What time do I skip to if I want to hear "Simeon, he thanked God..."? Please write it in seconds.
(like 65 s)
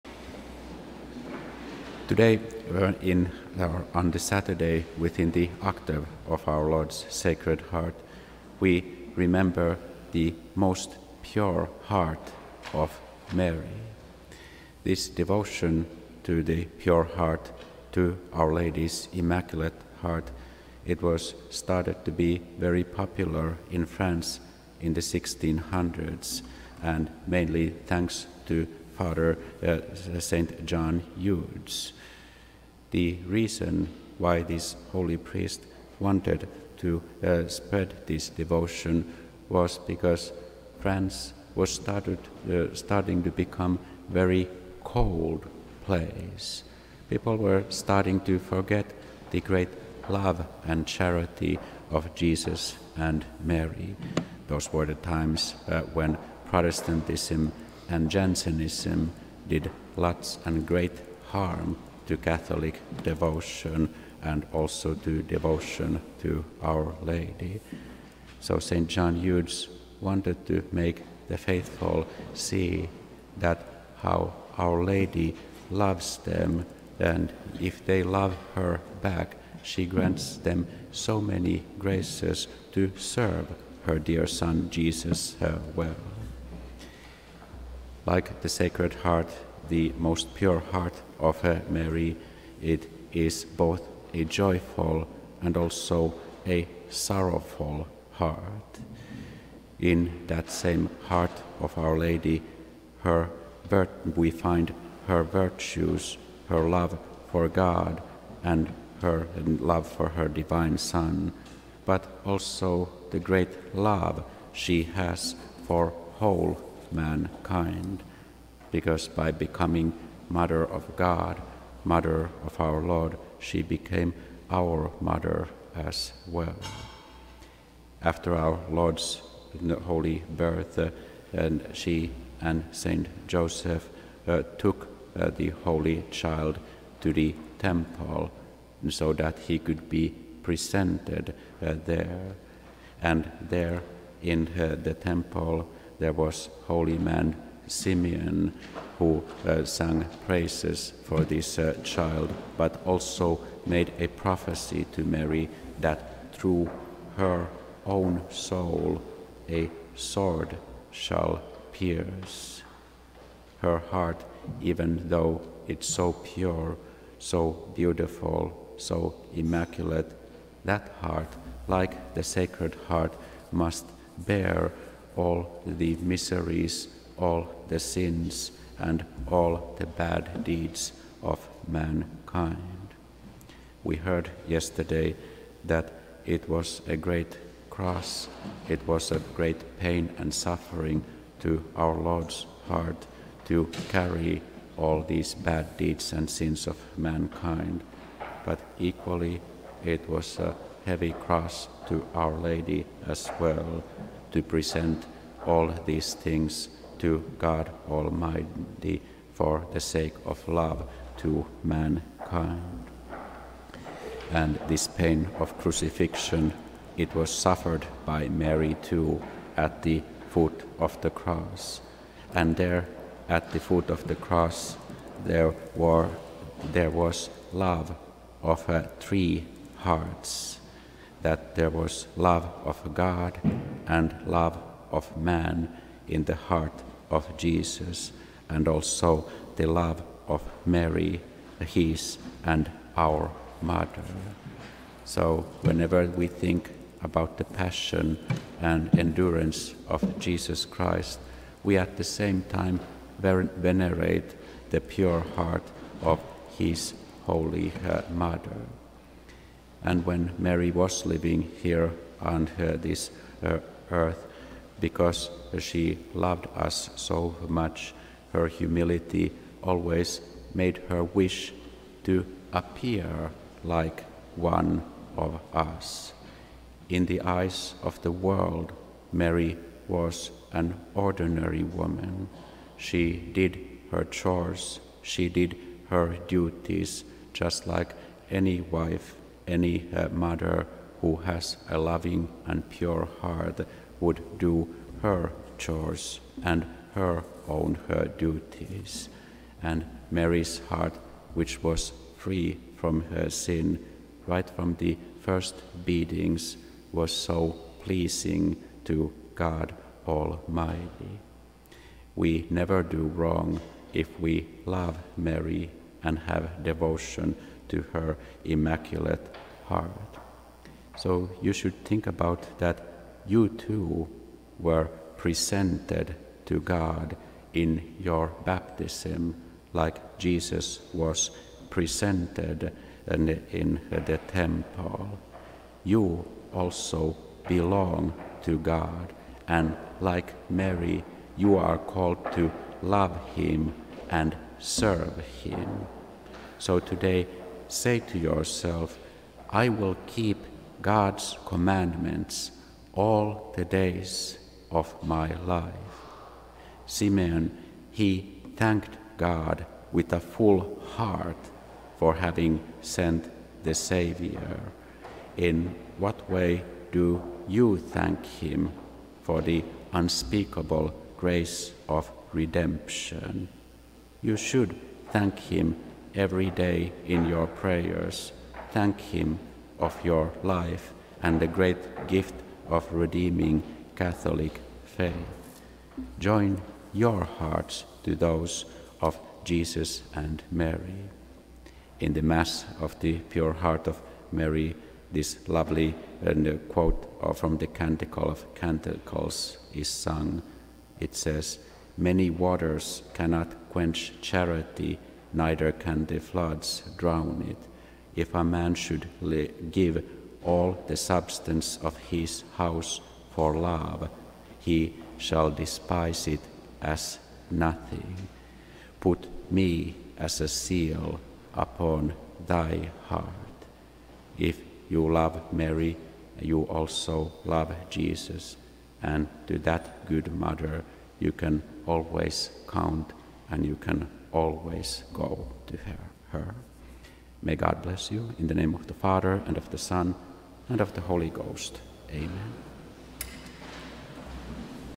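356 s.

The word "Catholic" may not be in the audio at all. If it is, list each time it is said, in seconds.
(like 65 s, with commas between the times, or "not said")
62 s, 383 s.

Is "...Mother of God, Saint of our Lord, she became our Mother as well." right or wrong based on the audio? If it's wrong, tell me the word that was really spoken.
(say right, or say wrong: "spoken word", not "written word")
wrong: "Mother", not "Saint".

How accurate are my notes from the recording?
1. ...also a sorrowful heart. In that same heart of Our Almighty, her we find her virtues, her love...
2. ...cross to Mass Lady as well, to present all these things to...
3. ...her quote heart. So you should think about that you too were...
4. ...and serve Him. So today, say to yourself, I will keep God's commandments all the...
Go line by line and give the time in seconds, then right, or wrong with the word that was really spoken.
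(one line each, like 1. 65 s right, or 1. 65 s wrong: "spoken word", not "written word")
1. 95 s wrong: "Lady", not "Almighty"
2. 201 s wrong: "Our", not "Mass"
3. 317 s wrong: "immaculate", not "quote"
4. 344 s right.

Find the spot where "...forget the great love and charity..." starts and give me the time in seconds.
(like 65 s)
48 s.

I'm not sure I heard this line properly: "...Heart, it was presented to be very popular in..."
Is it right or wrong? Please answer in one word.
wrong.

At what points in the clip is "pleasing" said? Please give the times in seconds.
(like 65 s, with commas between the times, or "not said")
307 s.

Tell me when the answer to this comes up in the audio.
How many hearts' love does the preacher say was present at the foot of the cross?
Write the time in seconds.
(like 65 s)
228 s.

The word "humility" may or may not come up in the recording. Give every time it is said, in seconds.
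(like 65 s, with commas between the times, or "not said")
268 s.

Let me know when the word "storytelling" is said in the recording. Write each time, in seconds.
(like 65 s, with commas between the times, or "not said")
not said.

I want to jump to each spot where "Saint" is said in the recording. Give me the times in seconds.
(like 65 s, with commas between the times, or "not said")
132 s.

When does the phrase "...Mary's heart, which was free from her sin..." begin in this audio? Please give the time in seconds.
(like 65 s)
300 s.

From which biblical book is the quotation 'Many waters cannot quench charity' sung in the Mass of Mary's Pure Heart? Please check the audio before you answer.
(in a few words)
Canticle of Canticles.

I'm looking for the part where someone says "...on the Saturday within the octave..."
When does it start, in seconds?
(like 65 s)
3 s.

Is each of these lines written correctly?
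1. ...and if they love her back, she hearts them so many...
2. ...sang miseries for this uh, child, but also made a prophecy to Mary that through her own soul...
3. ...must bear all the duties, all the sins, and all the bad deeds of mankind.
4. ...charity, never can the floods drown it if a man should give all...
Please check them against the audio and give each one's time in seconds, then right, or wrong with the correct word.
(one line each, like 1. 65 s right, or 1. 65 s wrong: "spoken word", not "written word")
1. 76 s wrong: "grants", not "hearts"
2. 149 s wrong: "praises", not "miseries"
3. 173 s wrong: "miseries", not "duties"
4. 404 s wrong: "neither", not "never".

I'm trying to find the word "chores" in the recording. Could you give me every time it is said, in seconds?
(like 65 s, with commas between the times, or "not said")
284 s, 295 s.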